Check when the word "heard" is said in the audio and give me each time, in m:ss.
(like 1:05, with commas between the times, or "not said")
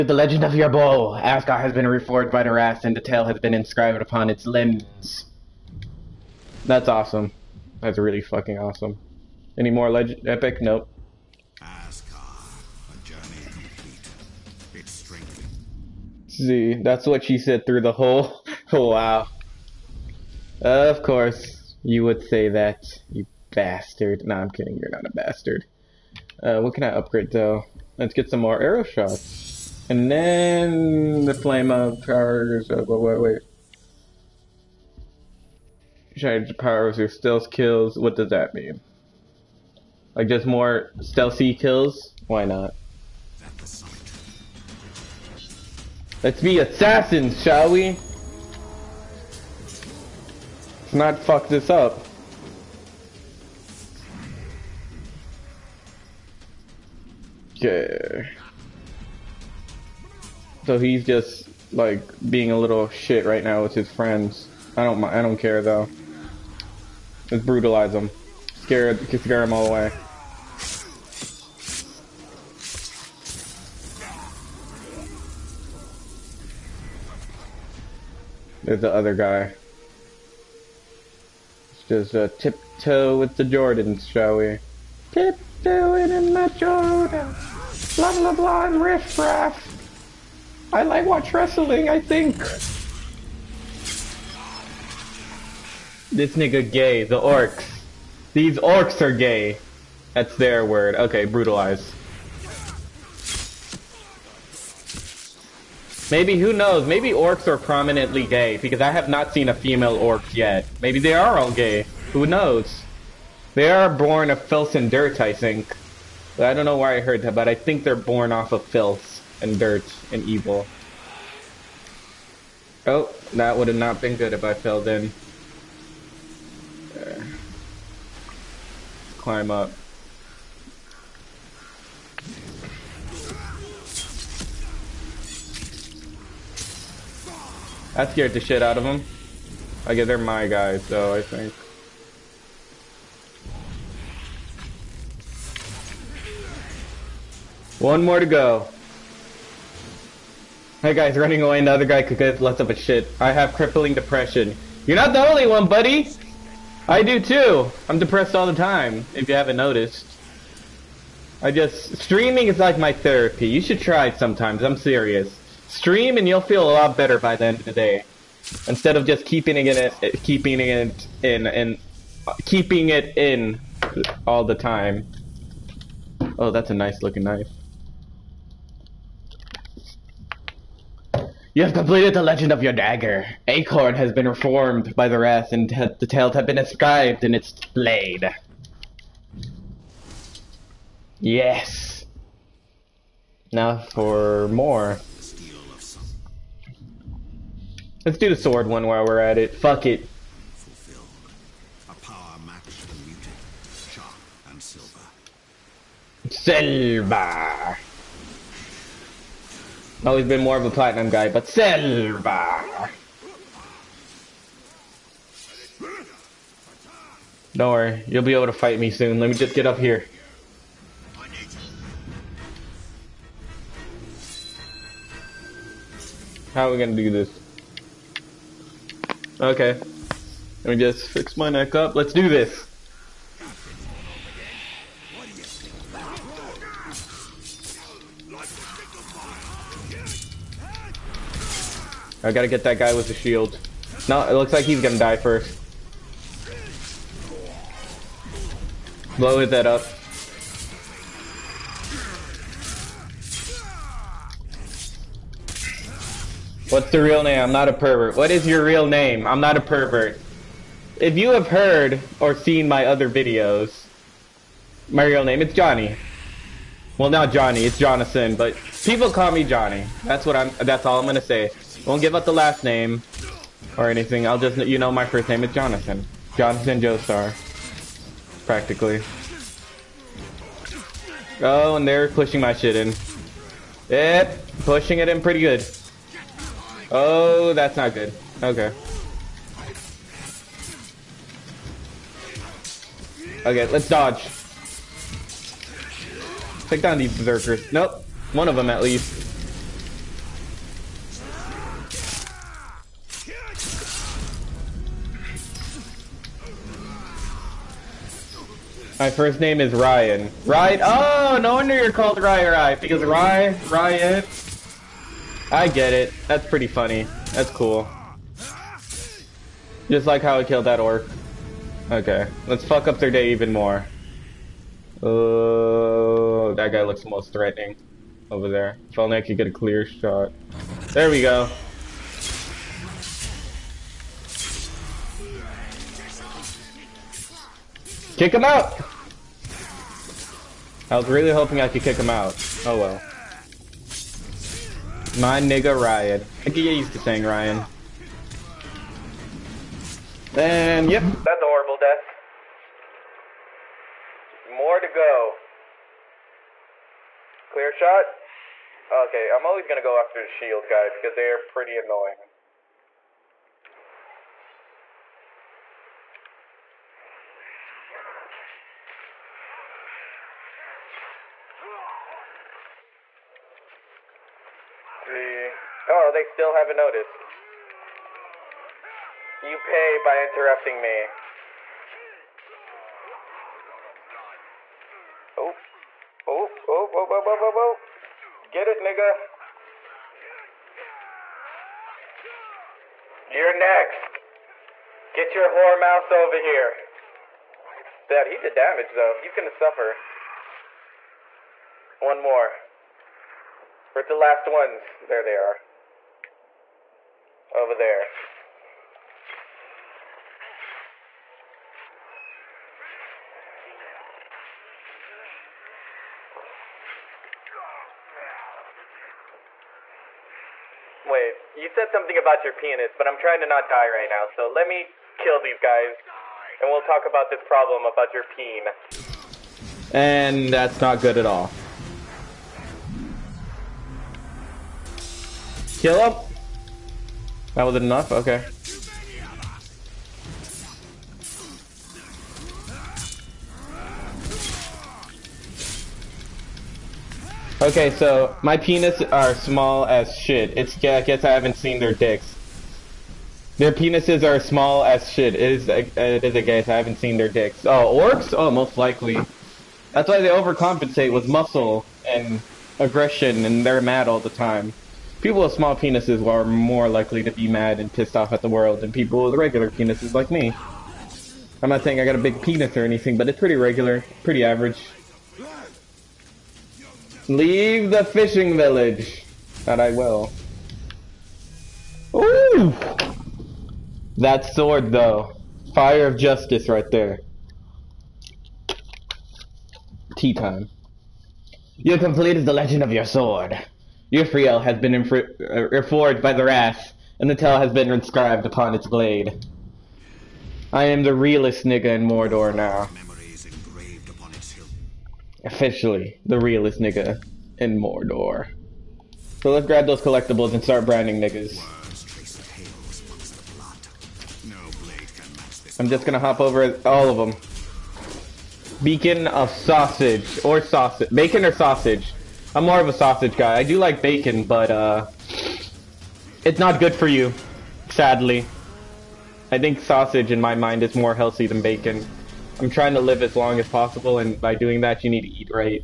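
1:56, 4:21.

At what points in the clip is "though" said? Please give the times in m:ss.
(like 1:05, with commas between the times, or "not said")
0:27, 1:05, 6:38, 8:04.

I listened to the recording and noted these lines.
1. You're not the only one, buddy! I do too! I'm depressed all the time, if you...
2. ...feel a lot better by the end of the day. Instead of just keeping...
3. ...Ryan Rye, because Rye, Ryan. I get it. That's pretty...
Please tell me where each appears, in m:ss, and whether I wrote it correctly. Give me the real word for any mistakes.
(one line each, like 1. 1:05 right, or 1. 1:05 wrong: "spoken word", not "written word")
1. 2:34 right
2. 2:46 right
3. 5:12 right.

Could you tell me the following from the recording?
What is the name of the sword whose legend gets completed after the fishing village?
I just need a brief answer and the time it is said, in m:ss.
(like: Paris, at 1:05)
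Urfael, at 8:14.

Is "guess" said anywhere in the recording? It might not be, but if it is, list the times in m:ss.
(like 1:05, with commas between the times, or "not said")
2:19, 7:31, 7:36.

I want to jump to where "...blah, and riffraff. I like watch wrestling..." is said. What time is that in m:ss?
1:28.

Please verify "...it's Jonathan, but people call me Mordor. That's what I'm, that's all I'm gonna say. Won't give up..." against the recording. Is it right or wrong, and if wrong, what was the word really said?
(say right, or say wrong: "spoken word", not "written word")
wrong: "Johnny", not "Mordor".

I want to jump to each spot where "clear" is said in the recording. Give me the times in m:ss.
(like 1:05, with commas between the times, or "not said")
5:29, 5:57.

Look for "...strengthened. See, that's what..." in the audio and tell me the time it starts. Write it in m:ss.
0:14.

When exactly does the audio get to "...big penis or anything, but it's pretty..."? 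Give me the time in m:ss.
7:52.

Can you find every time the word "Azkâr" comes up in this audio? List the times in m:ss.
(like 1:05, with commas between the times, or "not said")
0:01, 0:11.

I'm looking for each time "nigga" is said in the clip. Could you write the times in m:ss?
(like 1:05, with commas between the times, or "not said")
1:36, 5:45, 6:28, 8:21, 8:26, 8:31.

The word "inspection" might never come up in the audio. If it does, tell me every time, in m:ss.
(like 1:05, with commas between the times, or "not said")
not said.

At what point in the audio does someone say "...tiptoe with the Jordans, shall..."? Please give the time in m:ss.
1:22.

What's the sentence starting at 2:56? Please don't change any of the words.
Oh, that's a nice looking knife.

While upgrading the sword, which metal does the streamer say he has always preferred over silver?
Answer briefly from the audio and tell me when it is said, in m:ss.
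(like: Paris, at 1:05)
Platinum, at 3:30.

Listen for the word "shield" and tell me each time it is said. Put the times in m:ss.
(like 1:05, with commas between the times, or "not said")
4:03, 6:00.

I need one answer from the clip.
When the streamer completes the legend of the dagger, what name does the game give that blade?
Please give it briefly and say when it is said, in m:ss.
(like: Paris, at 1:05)
Acharn, at 3:03.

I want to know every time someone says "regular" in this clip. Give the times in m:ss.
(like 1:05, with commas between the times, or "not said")
7:49, 7:53.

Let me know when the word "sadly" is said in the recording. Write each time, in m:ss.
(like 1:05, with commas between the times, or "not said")
8:47.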